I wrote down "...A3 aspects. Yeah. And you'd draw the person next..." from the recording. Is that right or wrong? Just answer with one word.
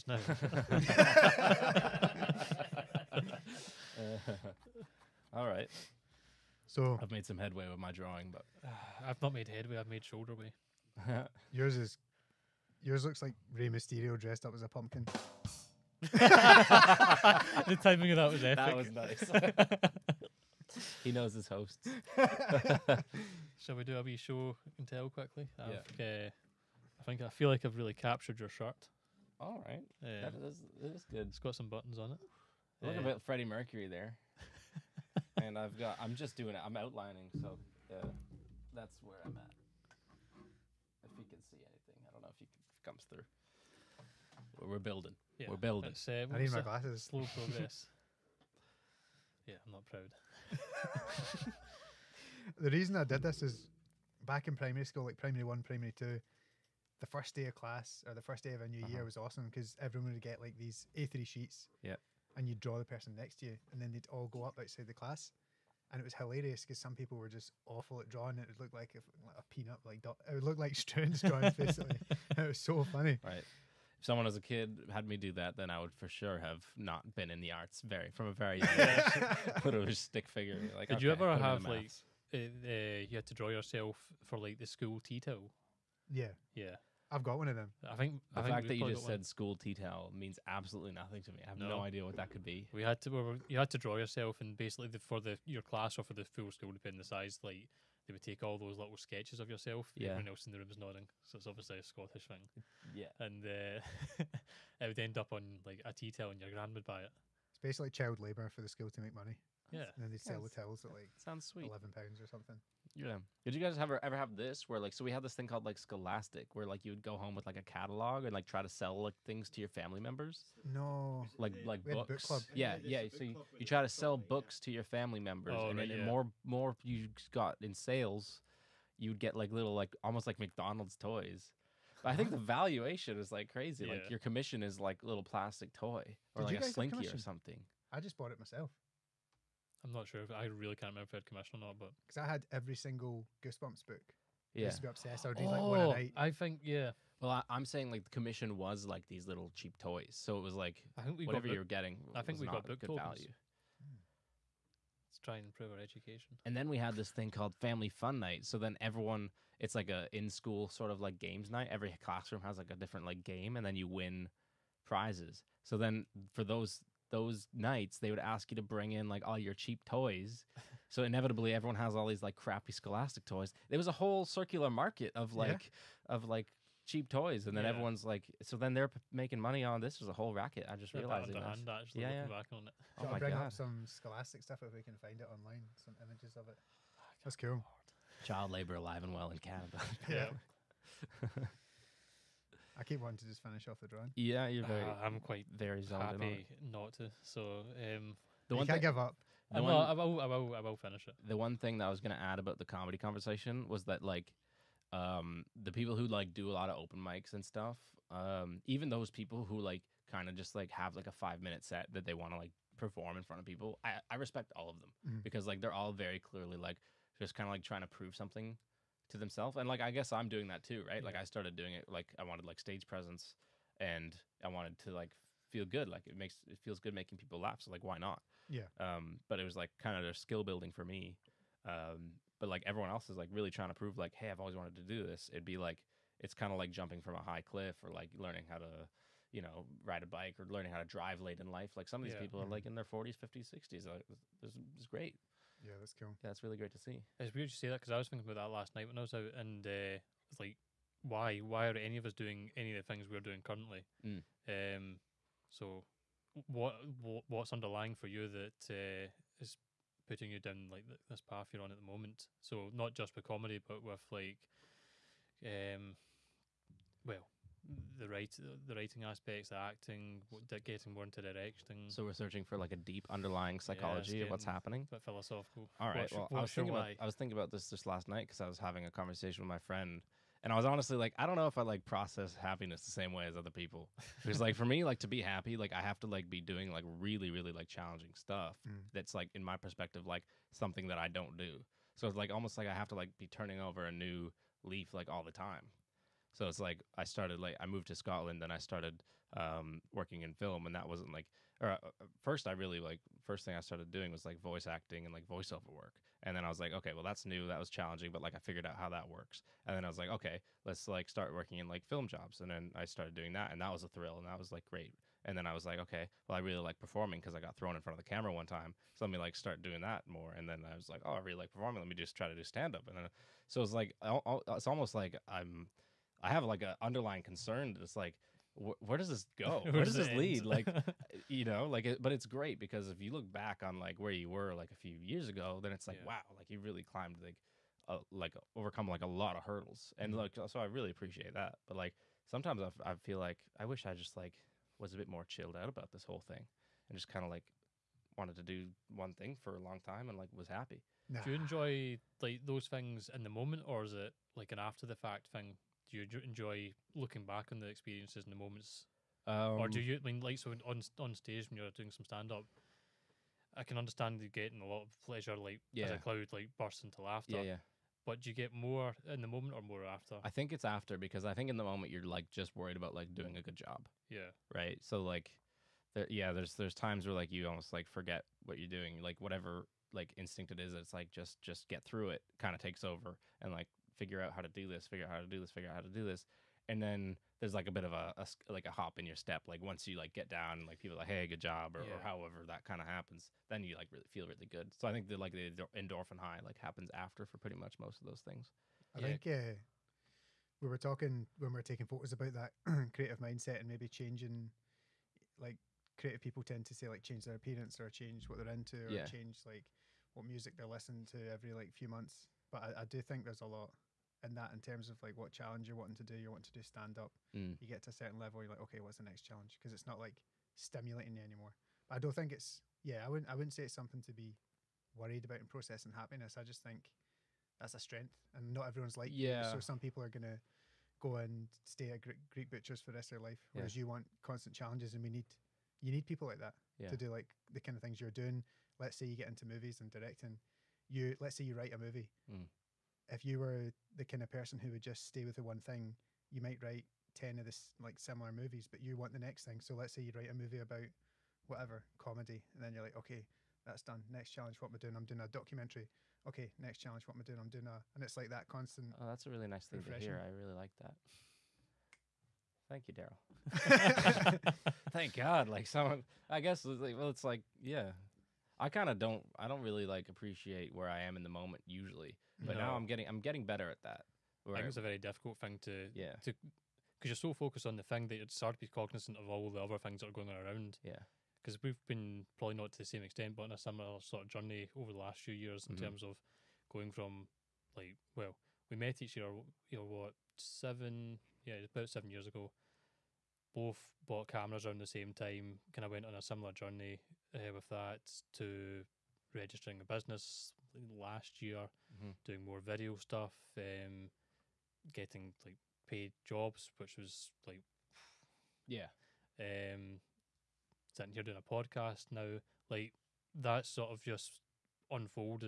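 wrong.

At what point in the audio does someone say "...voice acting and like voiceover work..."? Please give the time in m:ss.
5:04.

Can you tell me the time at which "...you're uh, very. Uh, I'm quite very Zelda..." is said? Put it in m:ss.
3:14.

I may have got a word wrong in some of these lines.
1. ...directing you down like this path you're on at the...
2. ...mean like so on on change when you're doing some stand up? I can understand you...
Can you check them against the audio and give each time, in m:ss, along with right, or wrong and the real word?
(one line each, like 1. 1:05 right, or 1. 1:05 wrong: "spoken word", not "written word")
1. 4:20 wrong: "putting", not "directing"
2. 6:00 wrong: "stage", not "change".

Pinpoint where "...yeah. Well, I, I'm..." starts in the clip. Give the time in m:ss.
2:26.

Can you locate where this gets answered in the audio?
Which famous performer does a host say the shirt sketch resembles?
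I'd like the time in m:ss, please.
0:33.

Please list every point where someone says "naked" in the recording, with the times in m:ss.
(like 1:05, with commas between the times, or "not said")
not said.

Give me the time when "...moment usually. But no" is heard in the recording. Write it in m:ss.
7:51.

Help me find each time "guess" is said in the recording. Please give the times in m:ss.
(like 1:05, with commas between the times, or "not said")
3:39, 7:46.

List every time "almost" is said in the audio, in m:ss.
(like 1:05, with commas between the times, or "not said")
2:10, 4:52, 5:24, 6:17.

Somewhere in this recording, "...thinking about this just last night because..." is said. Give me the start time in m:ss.
4:37.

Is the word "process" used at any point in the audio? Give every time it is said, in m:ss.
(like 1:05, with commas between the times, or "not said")
4:41, 7:05.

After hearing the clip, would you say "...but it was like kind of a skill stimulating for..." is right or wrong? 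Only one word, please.
wrong.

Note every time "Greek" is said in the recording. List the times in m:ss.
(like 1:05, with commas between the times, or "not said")
7:12.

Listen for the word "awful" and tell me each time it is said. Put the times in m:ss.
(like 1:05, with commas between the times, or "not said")
1:07.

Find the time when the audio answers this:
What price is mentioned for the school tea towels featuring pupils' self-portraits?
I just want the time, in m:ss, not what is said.
1:51.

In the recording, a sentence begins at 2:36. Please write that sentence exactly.
And then we had this thing called family fun night.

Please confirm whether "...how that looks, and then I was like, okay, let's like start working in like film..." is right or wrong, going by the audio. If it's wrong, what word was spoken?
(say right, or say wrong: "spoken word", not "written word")
wrong: "works", not "looks".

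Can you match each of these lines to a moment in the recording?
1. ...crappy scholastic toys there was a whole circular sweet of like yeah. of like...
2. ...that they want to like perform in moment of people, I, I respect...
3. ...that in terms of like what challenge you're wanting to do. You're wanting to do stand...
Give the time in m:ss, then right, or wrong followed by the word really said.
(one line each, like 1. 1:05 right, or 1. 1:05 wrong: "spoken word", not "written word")
1. 2:52 wrong: "market", not "sweet"
2. 3:31 wrong: "front", not "moment"
3. 6:54 right.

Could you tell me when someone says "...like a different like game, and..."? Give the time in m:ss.
2:42.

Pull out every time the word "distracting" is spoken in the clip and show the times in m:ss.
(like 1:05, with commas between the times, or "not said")
not said.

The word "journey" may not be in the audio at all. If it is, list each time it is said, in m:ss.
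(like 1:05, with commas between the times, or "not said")
8:04, 8:16.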